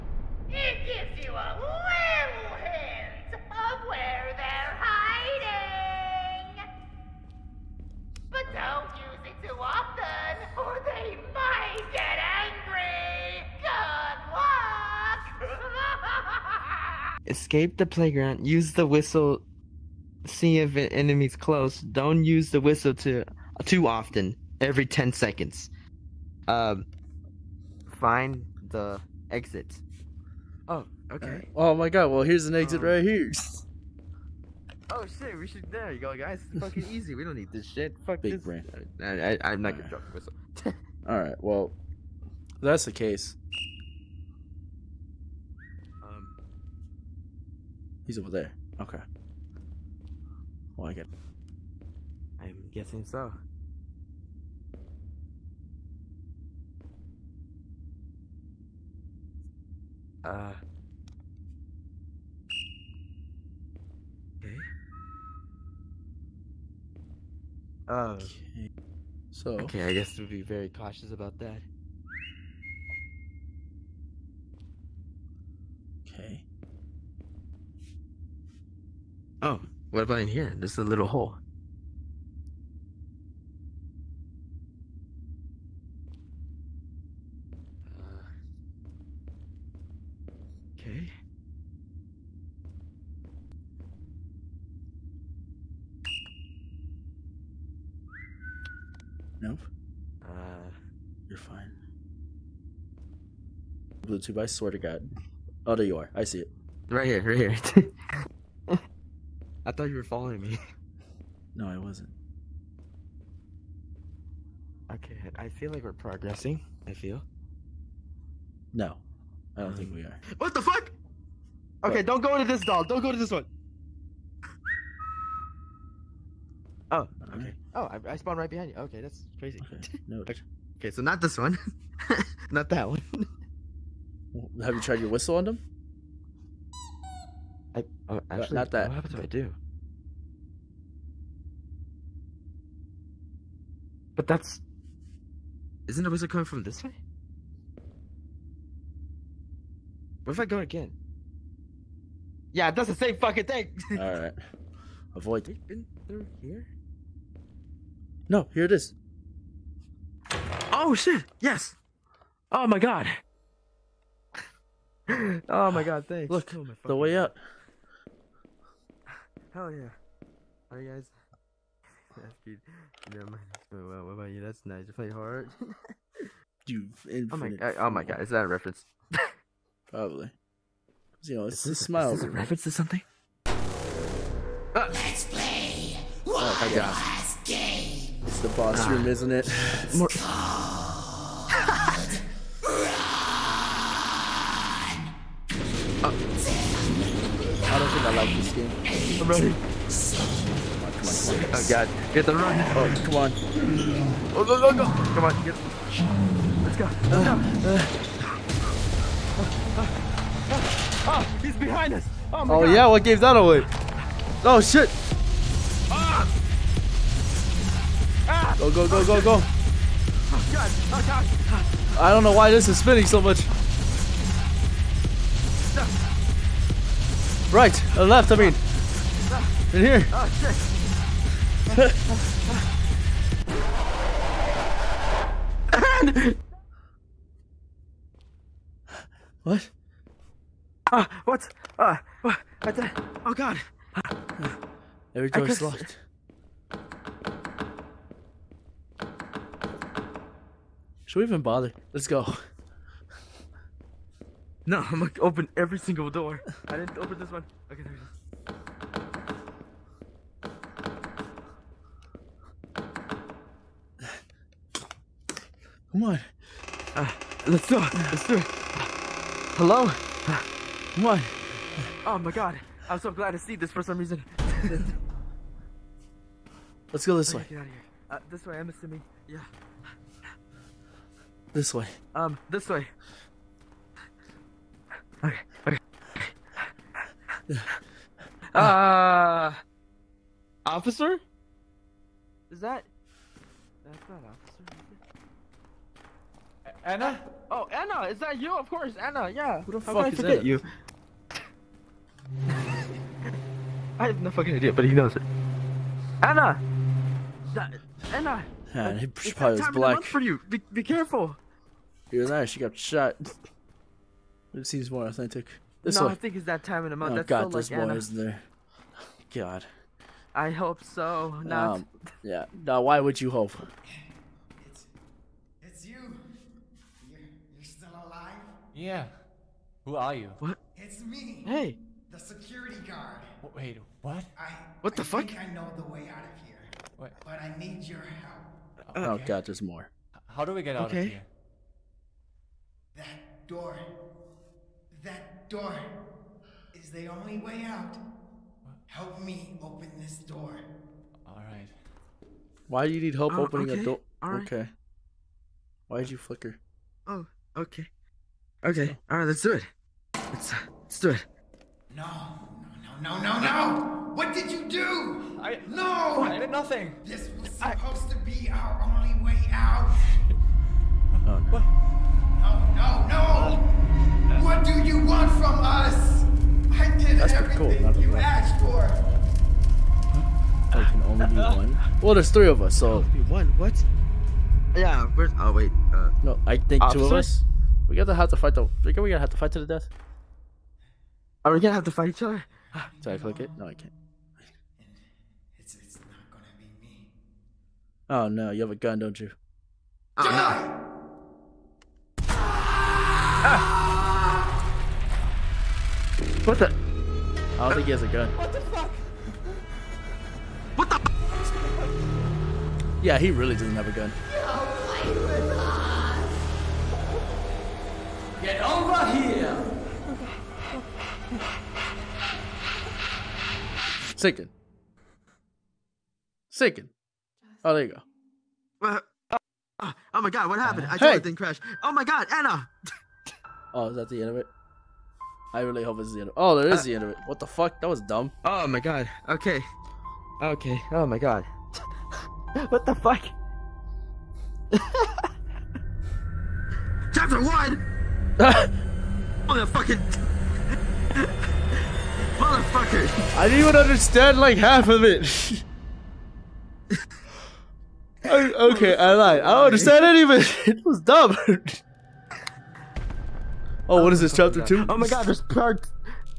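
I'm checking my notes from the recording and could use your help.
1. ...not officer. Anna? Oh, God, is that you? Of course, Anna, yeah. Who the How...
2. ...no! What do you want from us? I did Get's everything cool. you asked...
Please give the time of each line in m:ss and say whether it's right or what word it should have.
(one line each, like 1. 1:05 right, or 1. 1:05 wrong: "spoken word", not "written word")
1. 4:54 wrong: "Anna", not "God"
2. 6:13 wrong: "That", not "Get".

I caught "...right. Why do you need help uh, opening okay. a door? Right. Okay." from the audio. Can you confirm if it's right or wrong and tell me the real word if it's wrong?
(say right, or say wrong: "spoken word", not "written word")
right.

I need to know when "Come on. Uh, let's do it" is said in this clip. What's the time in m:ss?
4:25.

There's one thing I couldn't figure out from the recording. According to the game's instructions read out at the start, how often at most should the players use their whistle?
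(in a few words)
every 10 seconds.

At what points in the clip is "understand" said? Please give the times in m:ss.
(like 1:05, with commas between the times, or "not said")
7:33, 7:39.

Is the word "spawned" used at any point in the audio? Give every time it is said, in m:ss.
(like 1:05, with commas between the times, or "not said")
2:08.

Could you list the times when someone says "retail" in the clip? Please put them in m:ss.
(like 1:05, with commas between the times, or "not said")
not said.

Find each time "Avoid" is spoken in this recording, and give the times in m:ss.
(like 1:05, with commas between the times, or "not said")
2:35.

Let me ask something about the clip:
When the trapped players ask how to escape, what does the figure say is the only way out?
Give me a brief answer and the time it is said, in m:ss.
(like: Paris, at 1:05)
That door, at 5:45.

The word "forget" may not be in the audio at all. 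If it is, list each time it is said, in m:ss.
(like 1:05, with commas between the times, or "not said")
5:00.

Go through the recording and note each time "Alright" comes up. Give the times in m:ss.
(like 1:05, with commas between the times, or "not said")
0:41, 2:33, 2:50.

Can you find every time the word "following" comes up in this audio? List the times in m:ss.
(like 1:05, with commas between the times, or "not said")
1:50.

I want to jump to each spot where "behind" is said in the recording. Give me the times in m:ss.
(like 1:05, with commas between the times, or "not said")
2:08, 3:31.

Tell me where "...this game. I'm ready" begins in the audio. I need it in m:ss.
3:18.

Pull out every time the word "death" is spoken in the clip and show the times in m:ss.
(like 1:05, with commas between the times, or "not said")
6:29.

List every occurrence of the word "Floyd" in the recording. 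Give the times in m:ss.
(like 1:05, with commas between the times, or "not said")
not said.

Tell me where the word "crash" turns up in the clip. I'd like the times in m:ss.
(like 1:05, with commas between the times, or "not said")
7:11.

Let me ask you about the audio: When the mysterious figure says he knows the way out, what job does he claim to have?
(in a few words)
security guard.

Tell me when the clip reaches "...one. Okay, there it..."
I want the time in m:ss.
4:17.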